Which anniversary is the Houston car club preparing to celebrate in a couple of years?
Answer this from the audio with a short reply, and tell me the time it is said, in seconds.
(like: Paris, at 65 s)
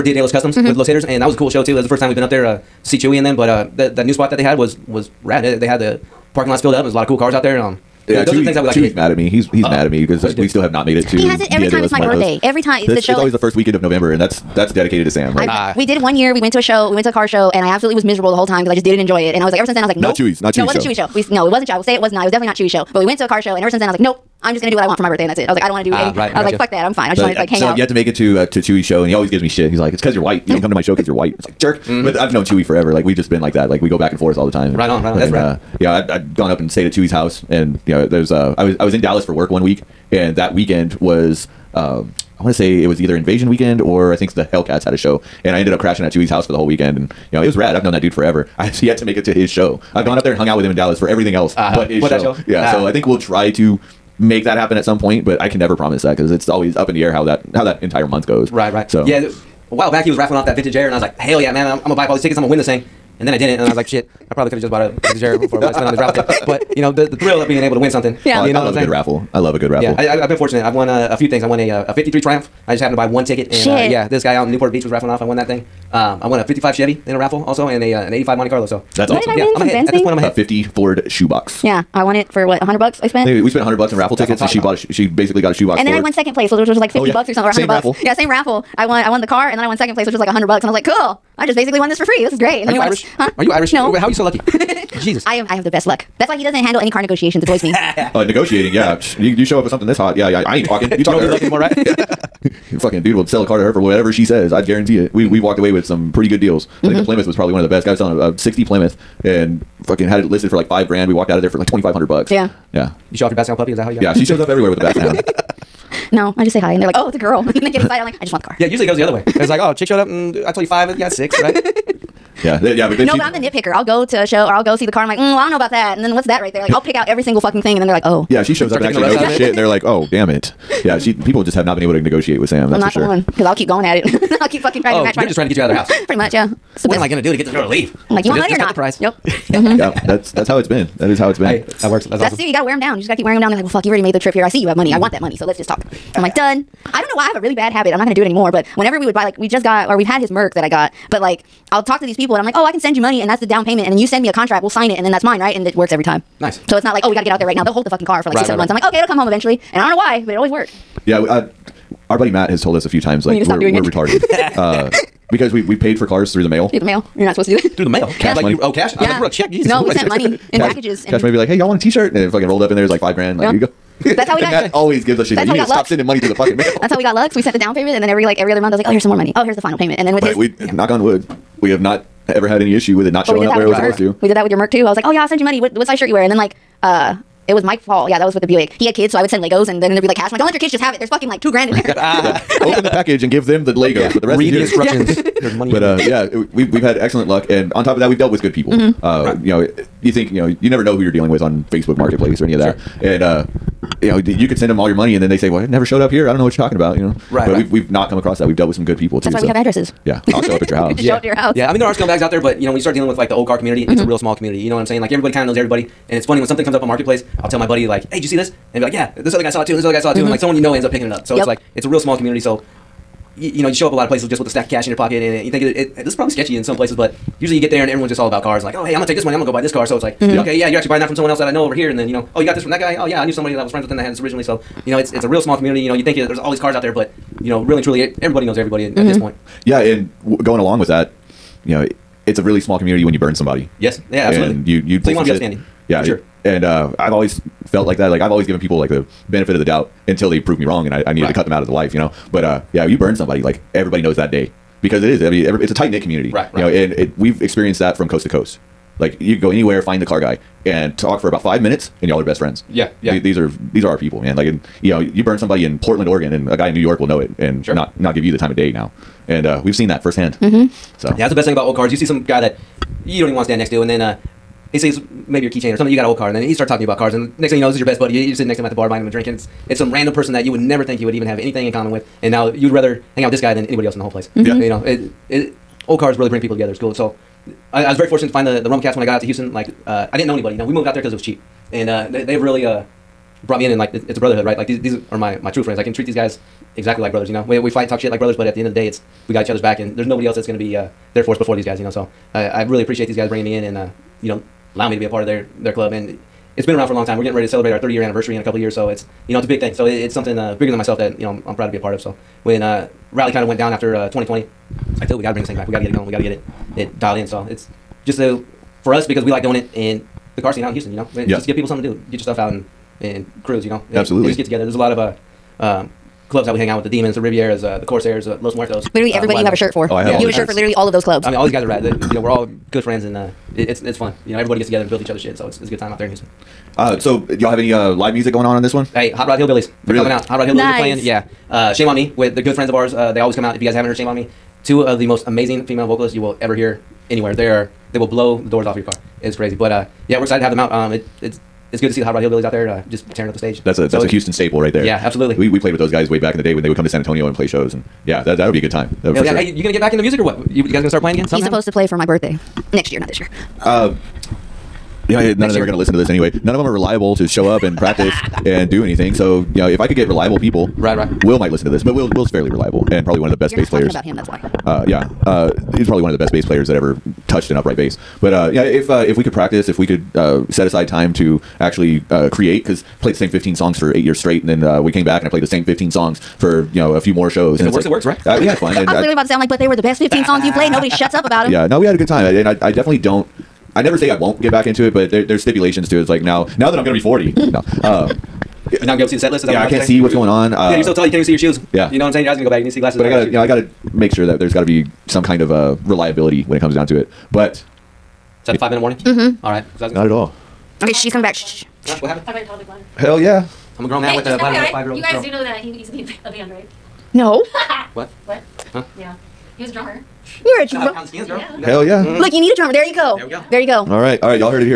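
30 year, at 307 s.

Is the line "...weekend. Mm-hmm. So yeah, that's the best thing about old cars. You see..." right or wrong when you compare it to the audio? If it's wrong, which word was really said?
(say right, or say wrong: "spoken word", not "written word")
wrong: "firsthand", not "weekend".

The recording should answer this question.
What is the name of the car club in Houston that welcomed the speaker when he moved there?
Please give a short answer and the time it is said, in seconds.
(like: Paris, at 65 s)
Rumble Cats, at 288 s.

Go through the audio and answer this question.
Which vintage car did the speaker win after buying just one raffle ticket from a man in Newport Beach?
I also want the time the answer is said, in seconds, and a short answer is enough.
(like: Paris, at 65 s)
53 Triumph, at 71 s.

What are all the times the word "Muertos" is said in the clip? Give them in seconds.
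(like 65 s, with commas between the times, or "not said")
11 s, 328 s.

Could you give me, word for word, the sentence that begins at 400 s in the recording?
Uh, yeah, you're uh, so tall, you can't even see your shoes.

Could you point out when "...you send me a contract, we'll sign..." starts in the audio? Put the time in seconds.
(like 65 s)
153 s.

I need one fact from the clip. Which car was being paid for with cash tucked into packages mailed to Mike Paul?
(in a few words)
the Buick.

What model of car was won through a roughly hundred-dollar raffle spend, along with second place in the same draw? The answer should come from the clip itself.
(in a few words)
50 Ford shoebox.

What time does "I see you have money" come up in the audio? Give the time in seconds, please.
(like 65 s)
144 s.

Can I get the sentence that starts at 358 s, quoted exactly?
Yeah, that that'll be a good time.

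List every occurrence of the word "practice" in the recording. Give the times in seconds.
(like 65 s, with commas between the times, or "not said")
367 s, 379 s.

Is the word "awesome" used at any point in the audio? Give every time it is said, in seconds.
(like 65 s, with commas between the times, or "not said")
79 s, 142 s.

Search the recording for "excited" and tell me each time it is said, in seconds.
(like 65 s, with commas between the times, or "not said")
117 s, 350 s.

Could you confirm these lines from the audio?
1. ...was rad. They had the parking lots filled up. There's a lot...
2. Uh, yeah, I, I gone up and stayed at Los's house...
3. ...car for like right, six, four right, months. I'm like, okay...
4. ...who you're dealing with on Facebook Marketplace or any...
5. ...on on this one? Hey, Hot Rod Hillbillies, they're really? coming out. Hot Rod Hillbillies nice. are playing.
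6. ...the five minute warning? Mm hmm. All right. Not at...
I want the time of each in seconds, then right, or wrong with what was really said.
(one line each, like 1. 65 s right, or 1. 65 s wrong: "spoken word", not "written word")
1. 4 s right
2. 35 s wrong: "Chewy", not "Los"
3. 158 s wrong: "seven", not "four"
4. 200 s right
5. 338 s right
6. 408 s right.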